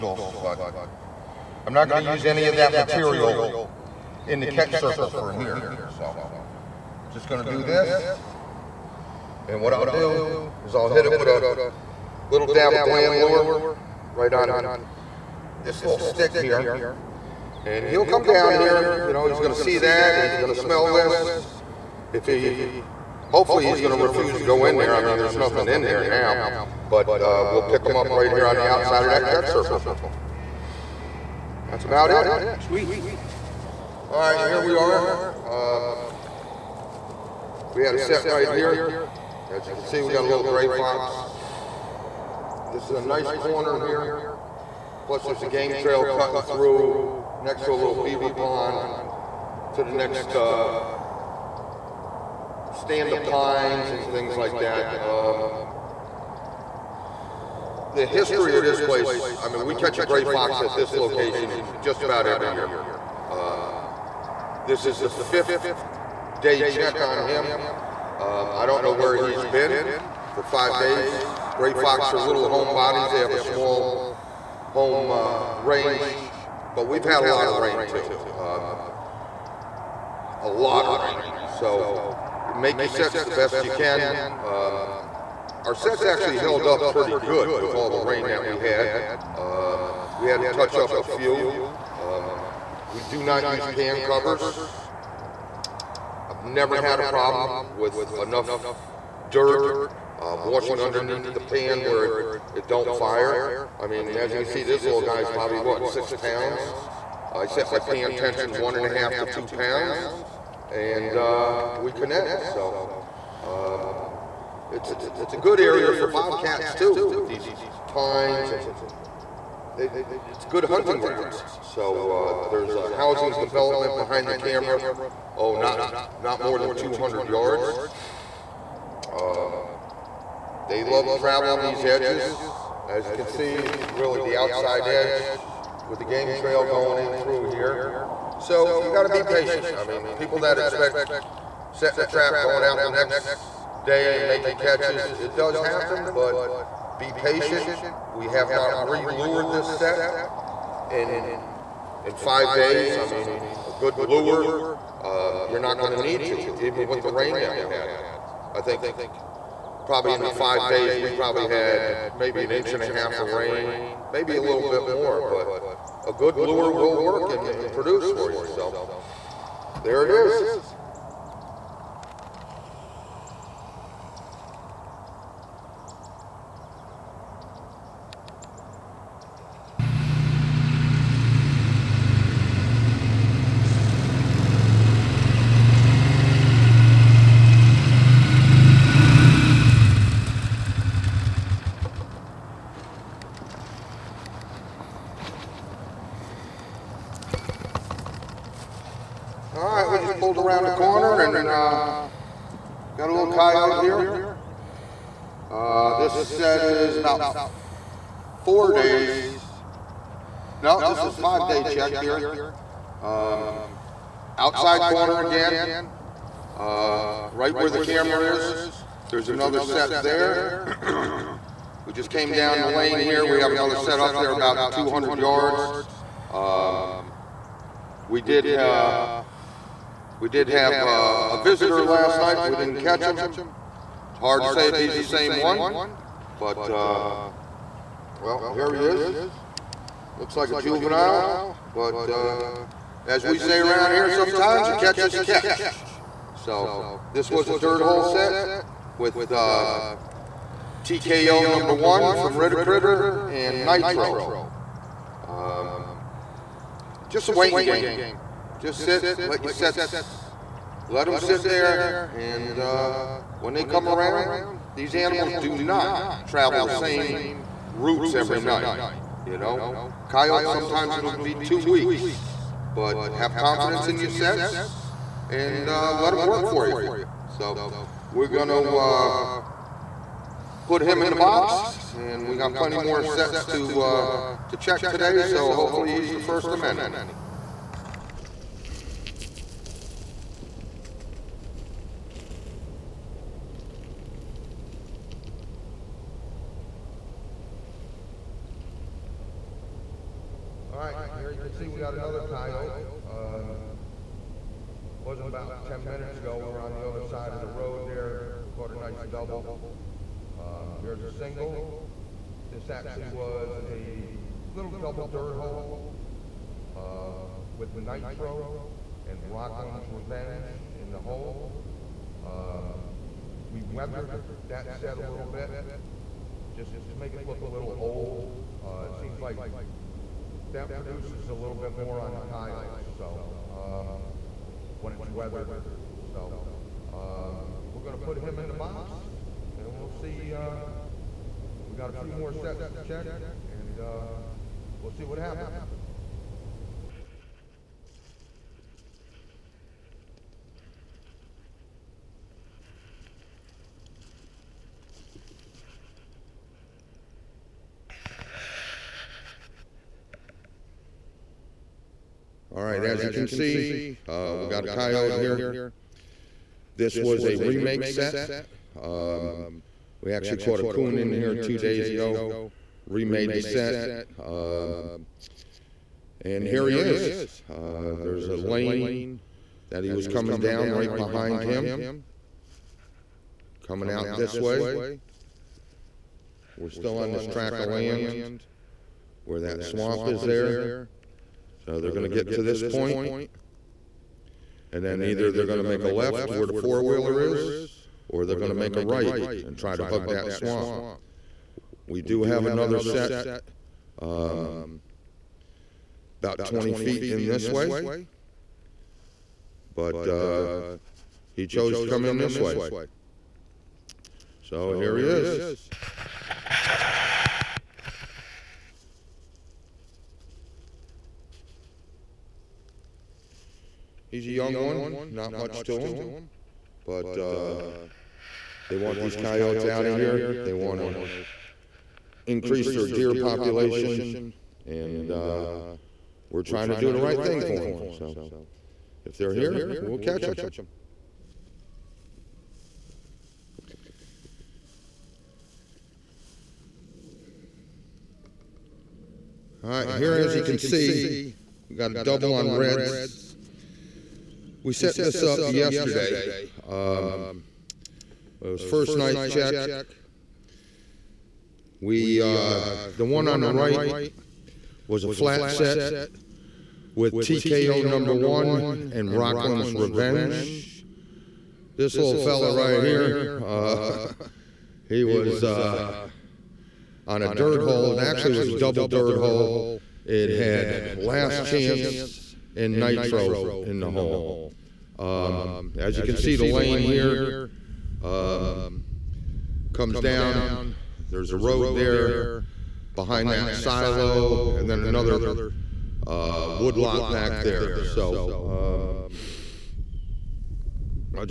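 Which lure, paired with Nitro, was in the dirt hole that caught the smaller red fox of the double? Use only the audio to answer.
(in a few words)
Last Chance.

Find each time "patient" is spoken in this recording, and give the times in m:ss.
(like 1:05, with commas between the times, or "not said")
2:19, 2:27.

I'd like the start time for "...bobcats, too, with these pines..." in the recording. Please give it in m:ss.
1:56.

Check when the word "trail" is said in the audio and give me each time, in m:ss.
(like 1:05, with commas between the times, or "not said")
0:45, 2:16.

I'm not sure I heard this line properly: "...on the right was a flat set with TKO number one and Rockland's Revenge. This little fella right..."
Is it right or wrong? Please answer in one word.
right.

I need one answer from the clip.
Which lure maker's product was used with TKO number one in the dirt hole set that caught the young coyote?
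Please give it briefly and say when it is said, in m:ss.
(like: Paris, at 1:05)
Ritter, at 4:12.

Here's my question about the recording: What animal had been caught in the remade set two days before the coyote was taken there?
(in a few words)
Coon.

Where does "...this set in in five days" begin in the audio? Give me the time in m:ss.
2:29.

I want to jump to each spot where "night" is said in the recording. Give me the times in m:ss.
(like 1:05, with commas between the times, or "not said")
3:52, 4:28, 7:38.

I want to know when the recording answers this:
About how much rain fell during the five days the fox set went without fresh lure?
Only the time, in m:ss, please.
2:42.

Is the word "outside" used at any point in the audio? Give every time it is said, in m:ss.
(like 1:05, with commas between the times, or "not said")
0:28, 2:14, 3:34.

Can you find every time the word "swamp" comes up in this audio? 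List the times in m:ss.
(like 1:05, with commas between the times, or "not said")
6:29, 6:40.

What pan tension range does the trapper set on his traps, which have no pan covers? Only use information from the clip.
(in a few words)
1.5 to 2 pounds.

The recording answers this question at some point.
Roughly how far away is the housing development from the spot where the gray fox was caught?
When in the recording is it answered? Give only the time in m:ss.
2:06.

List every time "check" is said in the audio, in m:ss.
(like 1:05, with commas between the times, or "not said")
1:06, 3:31, 4:44, 5:42, 7:39.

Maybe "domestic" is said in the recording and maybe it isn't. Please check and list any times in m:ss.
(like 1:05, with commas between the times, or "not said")
not said.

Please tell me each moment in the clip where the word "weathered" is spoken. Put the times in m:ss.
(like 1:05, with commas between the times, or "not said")
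5:23, 5:35.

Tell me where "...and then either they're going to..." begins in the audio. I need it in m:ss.
6:34.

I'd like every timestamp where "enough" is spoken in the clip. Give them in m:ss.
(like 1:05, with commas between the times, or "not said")
1:38.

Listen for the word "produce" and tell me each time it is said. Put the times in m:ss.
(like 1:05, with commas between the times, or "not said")
2:47, 5:30.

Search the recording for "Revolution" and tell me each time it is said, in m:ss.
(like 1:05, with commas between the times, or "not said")
not said.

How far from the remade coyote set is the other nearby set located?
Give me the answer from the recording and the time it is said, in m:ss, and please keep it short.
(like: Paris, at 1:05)
20 feet, at 6:46.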